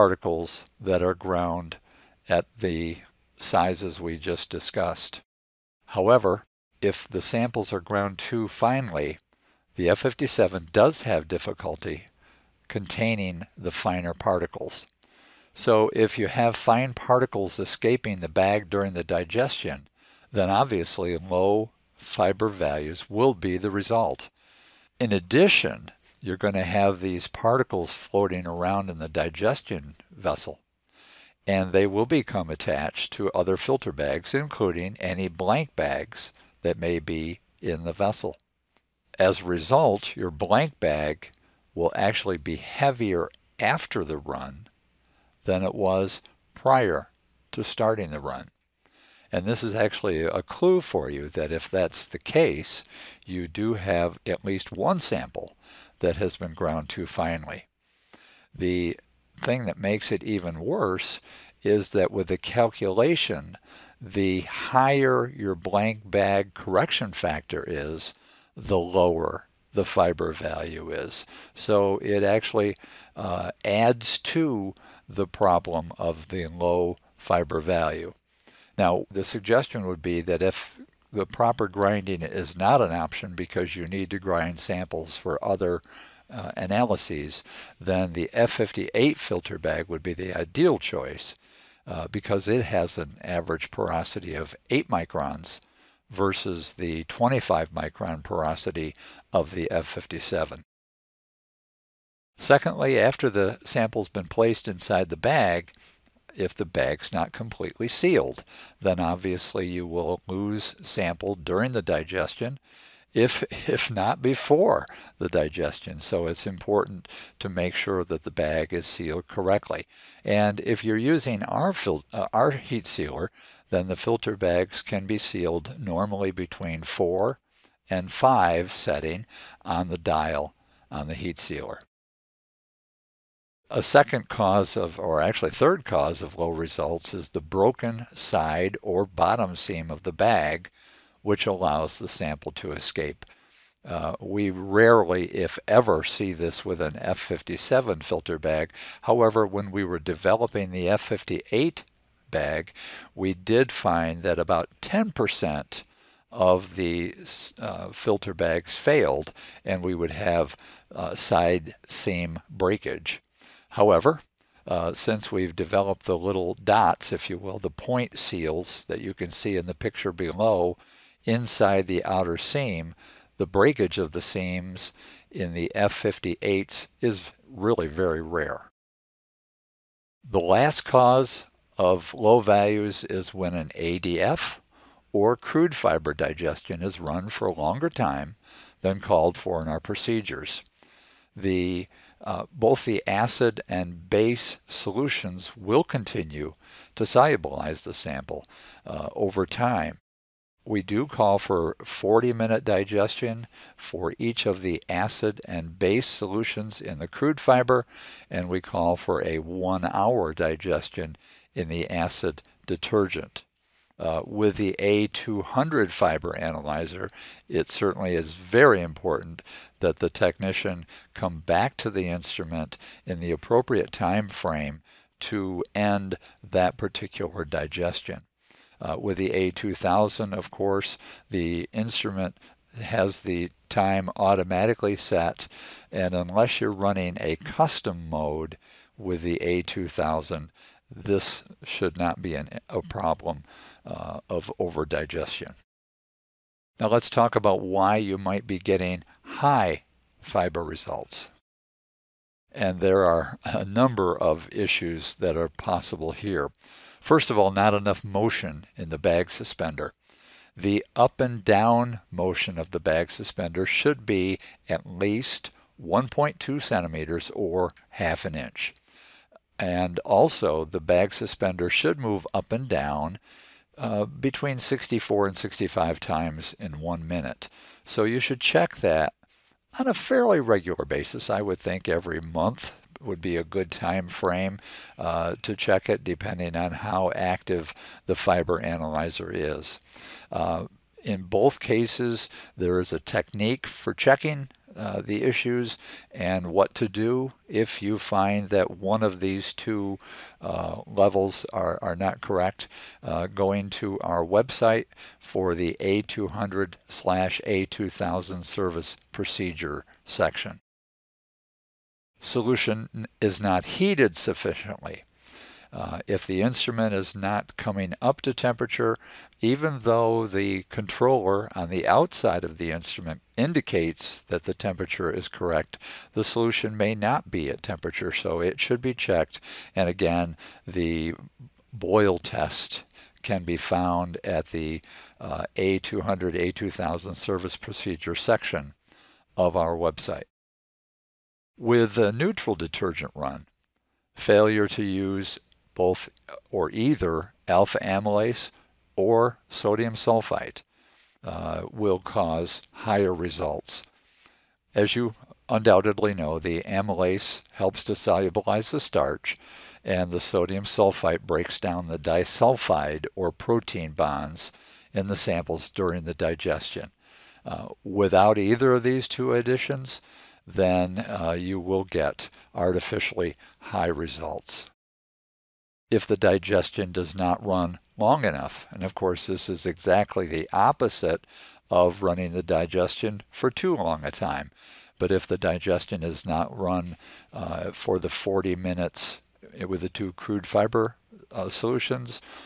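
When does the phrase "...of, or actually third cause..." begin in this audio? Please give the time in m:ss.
2:14.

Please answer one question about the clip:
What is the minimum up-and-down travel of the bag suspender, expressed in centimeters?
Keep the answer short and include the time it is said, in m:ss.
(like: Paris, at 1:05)
1.2 centimeters, at 4:25.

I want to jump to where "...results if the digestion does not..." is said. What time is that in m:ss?
6:13.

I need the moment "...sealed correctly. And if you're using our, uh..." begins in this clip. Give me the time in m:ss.
1:58.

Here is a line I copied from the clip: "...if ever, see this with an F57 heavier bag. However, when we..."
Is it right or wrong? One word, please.
wrong.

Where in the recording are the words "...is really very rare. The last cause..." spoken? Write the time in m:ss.
2:57.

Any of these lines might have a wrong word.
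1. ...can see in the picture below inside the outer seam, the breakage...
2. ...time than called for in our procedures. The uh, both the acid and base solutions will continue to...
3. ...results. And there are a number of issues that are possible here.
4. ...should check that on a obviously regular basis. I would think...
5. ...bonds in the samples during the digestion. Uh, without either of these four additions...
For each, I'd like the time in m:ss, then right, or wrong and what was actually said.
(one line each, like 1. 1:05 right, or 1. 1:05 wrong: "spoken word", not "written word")
1. 2:49 right
2. 3:07 right
3. 4:10 right
4. 4:38 wrong: "fairly", not "obviously"
5. 6:03 wrong: "two", not "four".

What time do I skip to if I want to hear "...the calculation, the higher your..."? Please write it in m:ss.
1:02.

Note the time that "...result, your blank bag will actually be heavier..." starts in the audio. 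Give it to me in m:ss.
0:39.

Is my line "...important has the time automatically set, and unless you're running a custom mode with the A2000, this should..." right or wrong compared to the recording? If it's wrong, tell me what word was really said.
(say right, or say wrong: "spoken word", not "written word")
wrong: "instrument", not "important".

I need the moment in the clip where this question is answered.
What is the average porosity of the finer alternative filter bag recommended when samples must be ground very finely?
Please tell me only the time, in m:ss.
1:34.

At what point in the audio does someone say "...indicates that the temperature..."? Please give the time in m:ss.
5:23.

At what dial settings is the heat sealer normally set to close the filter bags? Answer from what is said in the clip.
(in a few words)
between 4 and 5.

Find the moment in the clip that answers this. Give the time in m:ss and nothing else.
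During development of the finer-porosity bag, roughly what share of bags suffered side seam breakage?
2:34.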